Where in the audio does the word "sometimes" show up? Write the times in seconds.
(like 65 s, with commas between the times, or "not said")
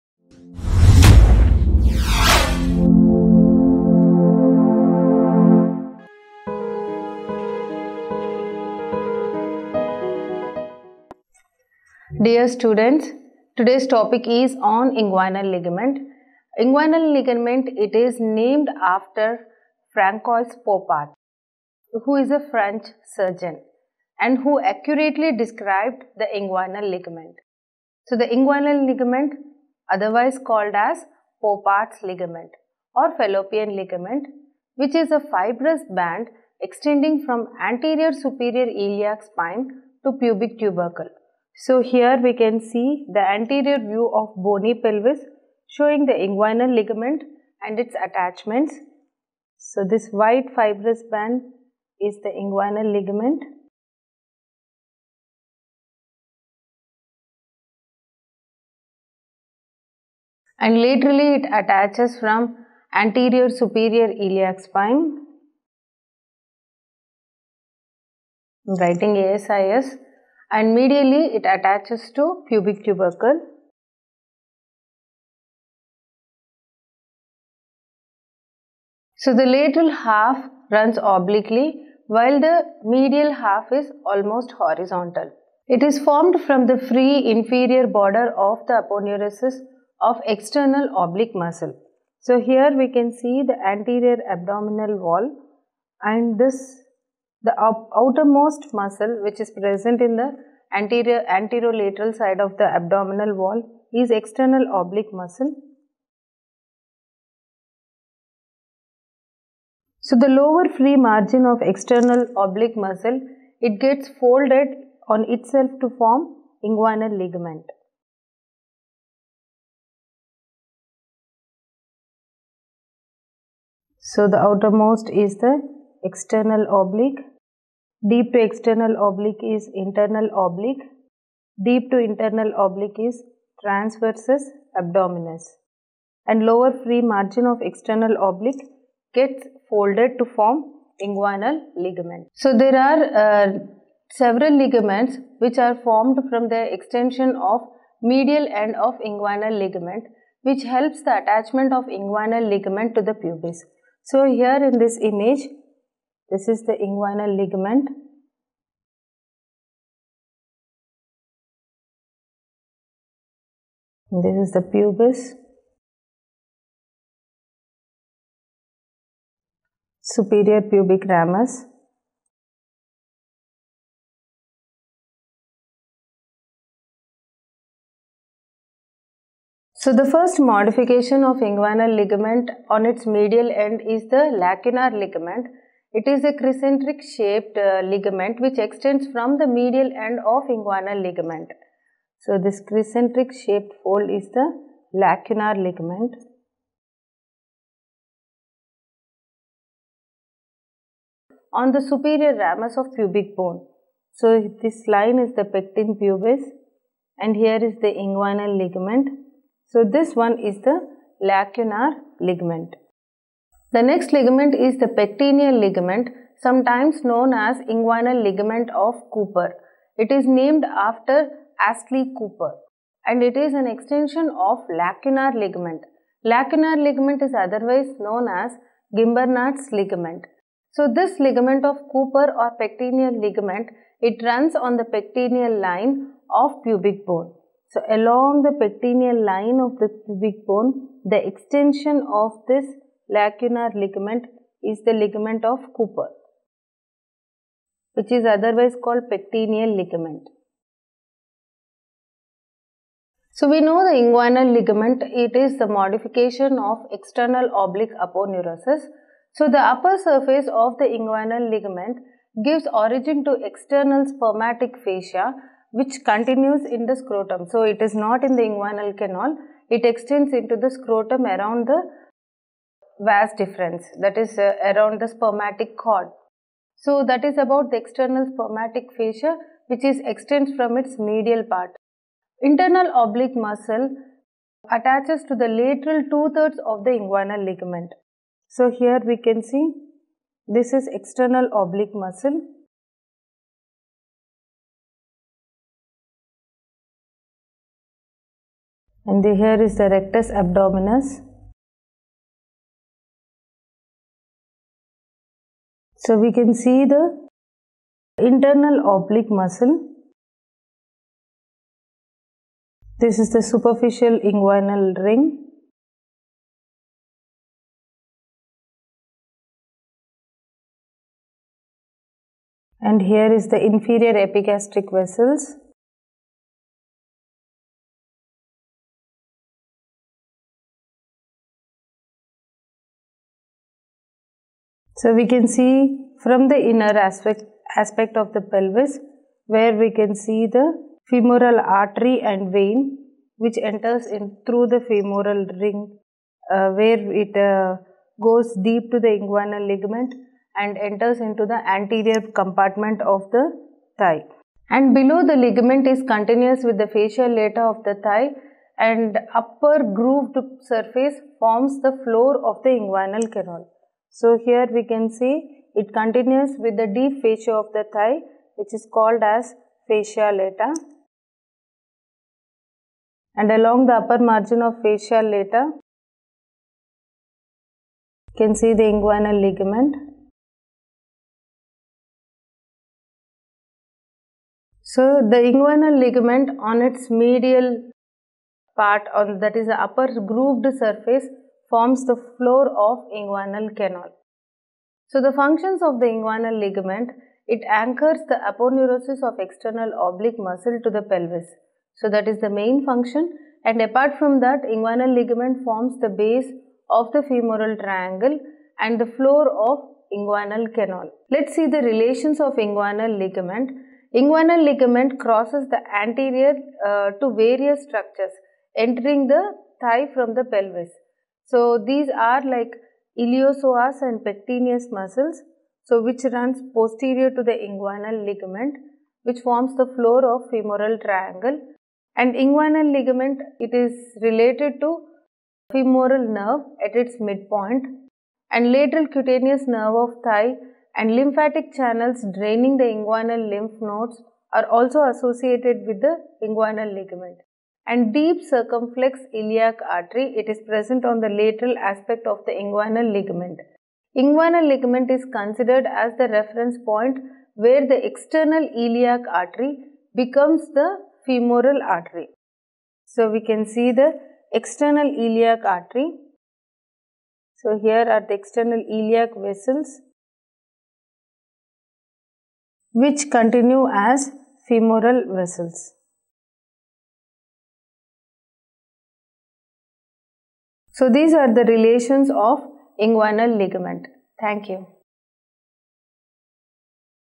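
216 s.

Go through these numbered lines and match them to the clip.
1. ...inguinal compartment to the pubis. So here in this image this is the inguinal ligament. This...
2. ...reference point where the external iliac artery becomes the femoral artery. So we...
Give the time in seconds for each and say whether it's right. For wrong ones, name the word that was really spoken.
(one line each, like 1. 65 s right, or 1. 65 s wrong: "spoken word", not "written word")
1. 151 s wrong: "ligament", not "compartment"
2. 456 s right.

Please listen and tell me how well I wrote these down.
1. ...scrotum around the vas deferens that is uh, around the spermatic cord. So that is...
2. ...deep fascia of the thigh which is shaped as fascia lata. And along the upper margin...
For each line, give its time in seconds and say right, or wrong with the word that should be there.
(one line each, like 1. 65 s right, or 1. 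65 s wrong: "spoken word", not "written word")
1. 270 s right
2. 366 s wrong: "called", not "shaped".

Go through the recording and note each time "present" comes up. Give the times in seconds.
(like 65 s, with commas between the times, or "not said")
99 s, 450 s.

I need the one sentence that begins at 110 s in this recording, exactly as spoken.
So the lower free margin of external oblique muscle, it gets folded on itself to form inguinal ligament.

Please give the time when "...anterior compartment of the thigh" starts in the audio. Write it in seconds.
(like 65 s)
351 s.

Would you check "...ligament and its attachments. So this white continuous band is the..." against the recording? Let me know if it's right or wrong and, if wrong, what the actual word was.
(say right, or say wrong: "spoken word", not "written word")
wrong: "fibrous", not "continuous".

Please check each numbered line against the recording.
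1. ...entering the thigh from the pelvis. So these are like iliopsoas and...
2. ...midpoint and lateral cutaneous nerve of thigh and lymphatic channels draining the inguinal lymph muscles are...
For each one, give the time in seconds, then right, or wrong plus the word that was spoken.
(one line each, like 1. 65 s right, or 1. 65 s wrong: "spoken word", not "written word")
1. 418 s right
2. 437 s wrong: "nodes", not "muscles".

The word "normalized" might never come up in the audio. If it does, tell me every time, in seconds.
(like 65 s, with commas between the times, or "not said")
not said.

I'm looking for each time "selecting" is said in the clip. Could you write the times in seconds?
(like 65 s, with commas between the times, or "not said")
not said.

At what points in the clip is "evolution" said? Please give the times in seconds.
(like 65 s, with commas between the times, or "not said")
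not said.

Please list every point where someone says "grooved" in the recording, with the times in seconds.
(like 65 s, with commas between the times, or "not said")
359 s, 390 s.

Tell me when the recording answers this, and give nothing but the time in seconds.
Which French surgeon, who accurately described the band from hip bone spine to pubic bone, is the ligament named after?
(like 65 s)
19 s.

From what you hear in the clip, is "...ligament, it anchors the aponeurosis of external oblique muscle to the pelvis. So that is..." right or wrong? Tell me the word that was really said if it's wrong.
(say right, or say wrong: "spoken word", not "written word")
right.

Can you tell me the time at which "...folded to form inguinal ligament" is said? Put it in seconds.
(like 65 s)
139 s.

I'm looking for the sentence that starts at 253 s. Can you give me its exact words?
So we know the inguinal ligament, it is the modification of external oblique aponeurosis.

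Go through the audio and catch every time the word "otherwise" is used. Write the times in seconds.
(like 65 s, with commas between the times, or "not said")
29 s, 227 s, 248 s.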